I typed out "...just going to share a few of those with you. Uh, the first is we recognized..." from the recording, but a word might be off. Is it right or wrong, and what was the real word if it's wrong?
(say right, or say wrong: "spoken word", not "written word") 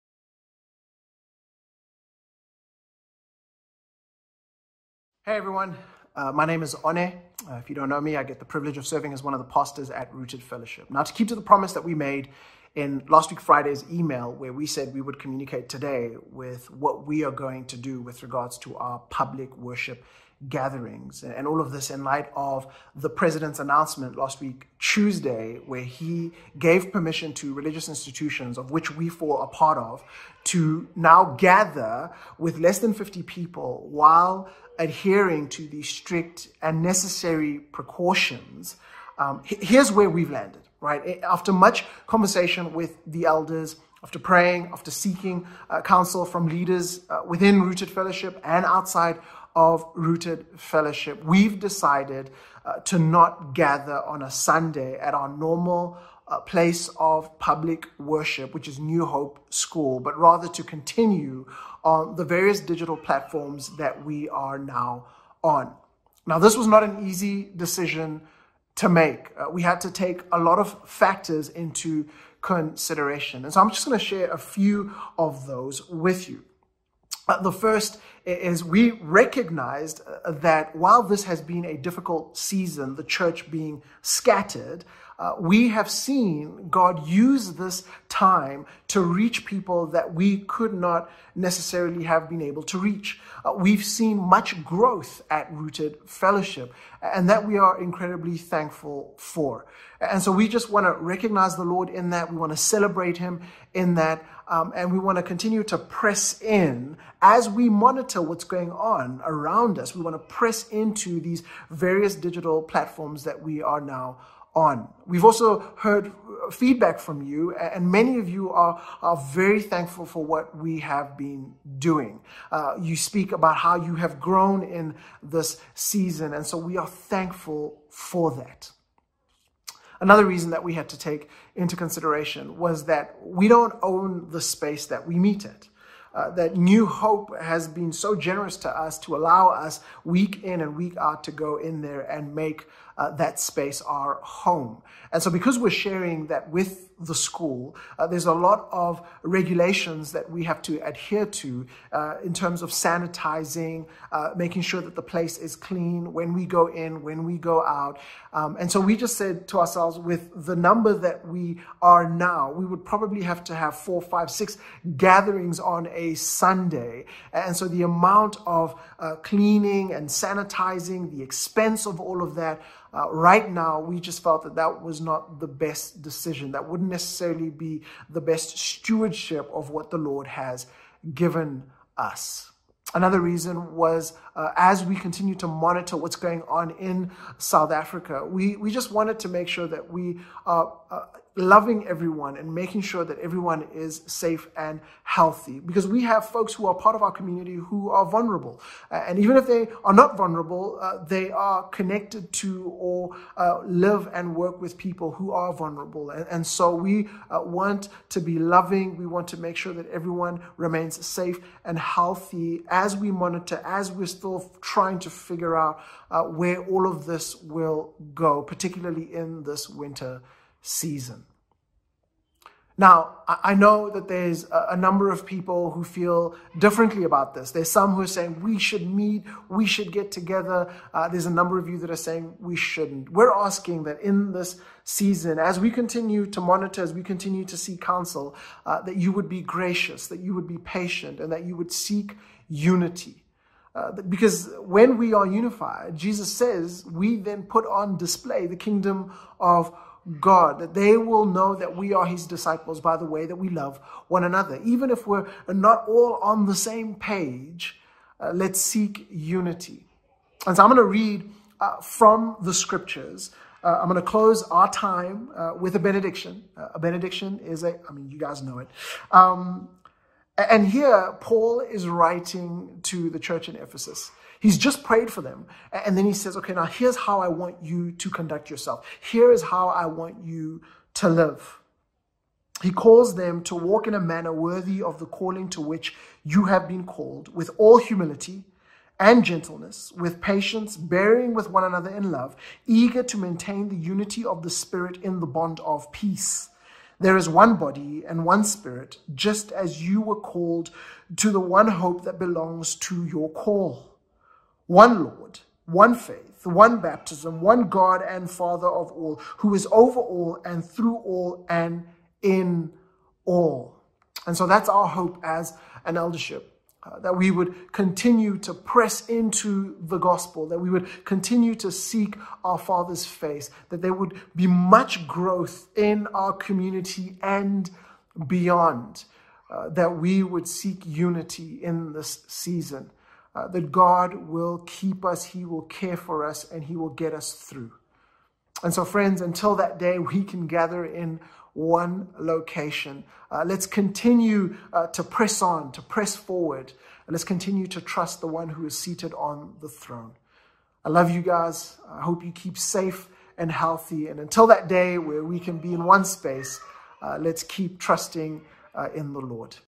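right.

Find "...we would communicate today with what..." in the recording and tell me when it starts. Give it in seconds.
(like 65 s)
14 s.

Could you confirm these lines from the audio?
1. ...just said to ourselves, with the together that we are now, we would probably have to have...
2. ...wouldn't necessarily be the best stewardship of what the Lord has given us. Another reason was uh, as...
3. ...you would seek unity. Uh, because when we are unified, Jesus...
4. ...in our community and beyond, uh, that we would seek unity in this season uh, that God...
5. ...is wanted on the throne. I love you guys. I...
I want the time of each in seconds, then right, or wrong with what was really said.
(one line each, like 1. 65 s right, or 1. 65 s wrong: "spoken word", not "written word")
1. 158 s wrong: "number", not "together"
2. 176 s right
3. 241 s right
4. 325 s right
5. 348 s wrong: "seated", not "wanted".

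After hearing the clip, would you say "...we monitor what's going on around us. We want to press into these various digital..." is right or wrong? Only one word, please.
right.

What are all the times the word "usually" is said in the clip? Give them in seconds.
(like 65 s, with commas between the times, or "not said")
not said.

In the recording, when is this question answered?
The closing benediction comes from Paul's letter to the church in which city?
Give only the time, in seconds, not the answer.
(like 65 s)
273 s.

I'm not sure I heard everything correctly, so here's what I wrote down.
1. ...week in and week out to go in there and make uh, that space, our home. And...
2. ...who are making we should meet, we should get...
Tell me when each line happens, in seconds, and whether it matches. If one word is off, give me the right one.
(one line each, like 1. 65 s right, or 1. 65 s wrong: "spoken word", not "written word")
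1. 140 s right
2. 227 s wrong: "saying", not "making".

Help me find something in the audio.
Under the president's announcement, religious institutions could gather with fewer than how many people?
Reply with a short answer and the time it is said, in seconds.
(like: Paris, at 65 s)
50, at 32 s.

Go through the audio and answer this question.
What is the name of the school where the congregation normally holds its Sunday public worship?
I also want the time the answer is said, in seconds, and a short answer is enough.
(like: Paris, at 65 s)
New Hope School, at 58 s.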